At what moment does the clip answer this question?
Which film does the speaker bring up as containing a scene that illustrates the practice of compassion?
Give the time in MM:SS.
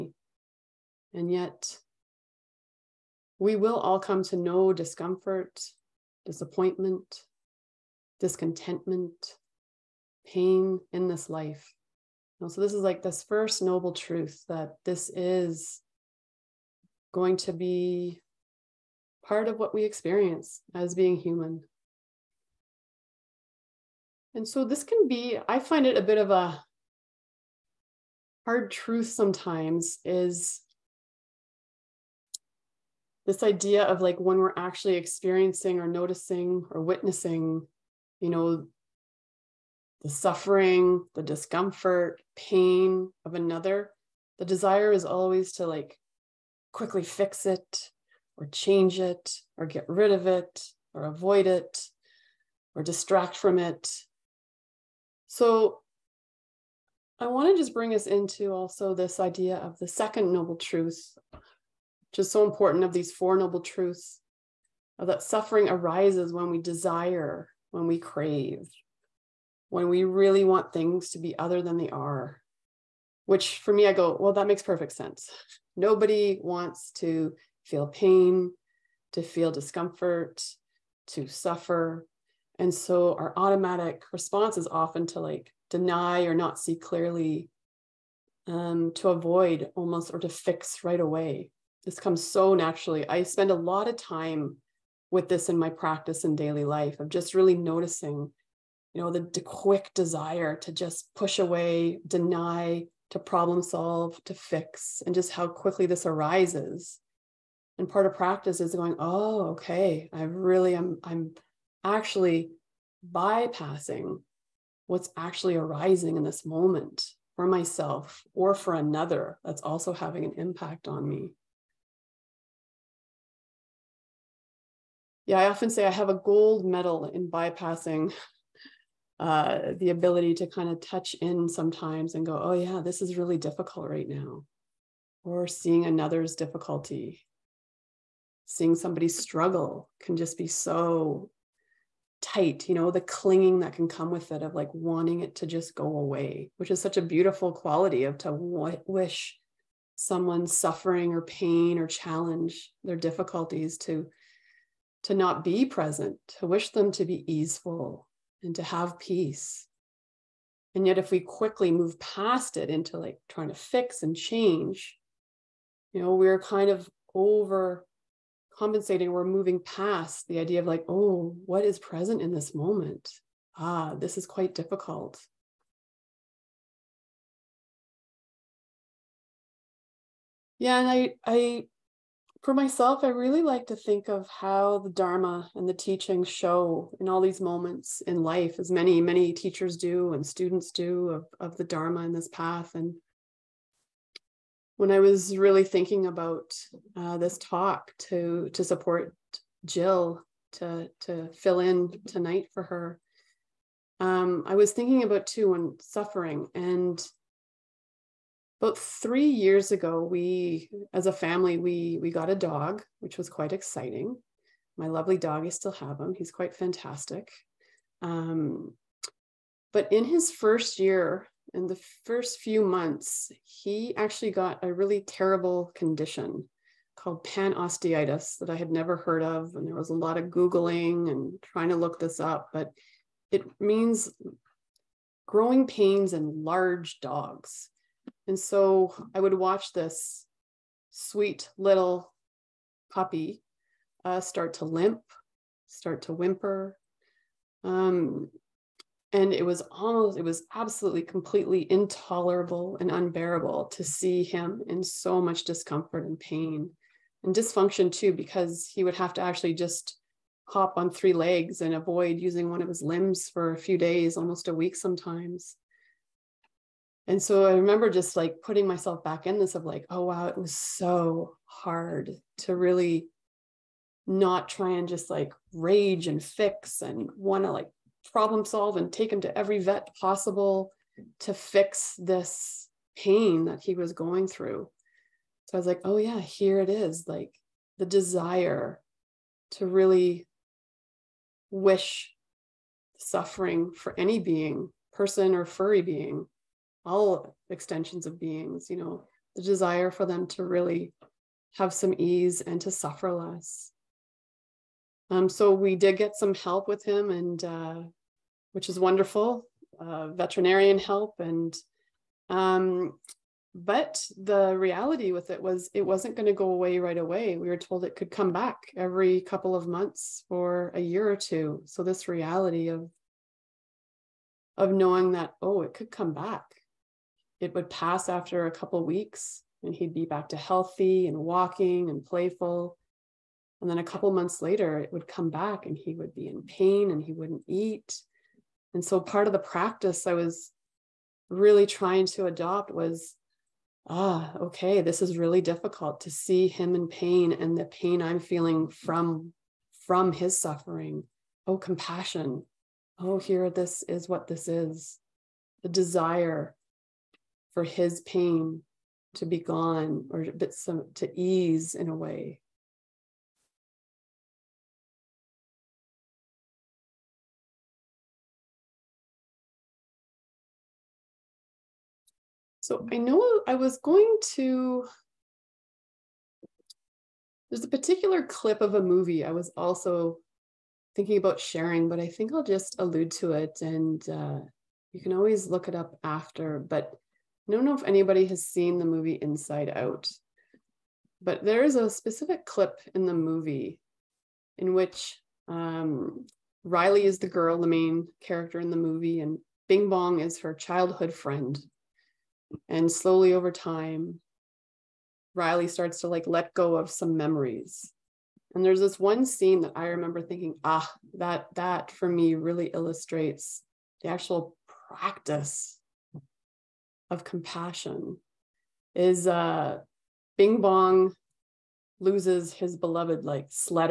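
06:29.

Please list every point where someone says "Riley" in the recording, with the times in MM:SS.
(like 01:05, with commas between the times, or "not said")
06:36, 06:45.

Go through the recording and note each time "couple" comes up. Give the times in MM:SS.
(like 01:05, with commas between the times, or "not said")
05:19, 05:28, 05:33.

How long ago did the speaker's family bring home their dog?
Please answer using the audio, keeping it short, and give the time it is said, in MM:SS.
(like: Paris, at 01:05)
3 years ago, at 03:28.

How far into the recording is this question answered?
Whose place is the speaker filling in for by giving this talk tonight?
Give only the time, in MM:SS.
03:19.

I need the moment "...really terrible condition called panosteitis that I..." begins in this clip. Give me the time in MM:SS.
03:44.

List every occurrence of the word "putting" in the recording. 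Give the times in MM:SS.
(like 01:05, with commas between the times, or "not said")
04:28.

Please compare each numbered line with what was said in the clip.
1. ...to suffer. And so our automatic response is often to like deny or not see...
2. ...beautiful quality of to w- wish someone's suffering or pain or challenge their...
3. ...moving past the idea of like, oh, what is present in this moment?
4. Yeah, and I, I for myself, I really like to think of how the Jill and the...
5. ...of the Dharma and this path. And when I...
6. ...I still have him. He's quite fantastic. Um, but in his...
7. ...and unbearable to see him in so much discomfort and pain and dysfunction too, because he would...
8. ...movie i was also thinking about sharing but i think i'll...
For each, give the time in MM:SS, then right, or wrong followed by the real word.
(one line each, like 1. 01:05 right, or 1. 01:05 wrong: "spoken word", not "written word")
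1. 01:21 right
2. 02:27 right
3. 02:49 right
4. 03:00 wrong: "Dharma", not "Jill"
5. 03:11 right
6. 03:35 right
7. 04:12 right
8. 06:18 right.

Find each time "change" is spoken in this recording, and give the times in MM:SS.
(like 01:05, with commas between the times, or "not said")
00:48, 02:44.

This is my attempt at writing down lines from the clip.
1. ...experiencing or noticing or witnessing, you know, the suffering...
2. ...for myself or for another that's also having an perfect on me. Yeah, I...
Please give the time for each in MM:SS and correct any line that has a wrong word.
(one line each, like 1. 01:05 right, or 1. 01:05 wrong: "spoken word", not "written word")
1. 00:34 right
2. 01:57 wrong: "impact", not "perfect".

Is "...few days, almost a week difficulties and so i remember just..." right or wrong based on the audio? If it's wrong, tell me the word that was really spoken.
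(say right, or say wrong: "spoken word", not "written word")
wrong: "sometimes", not "difficulties".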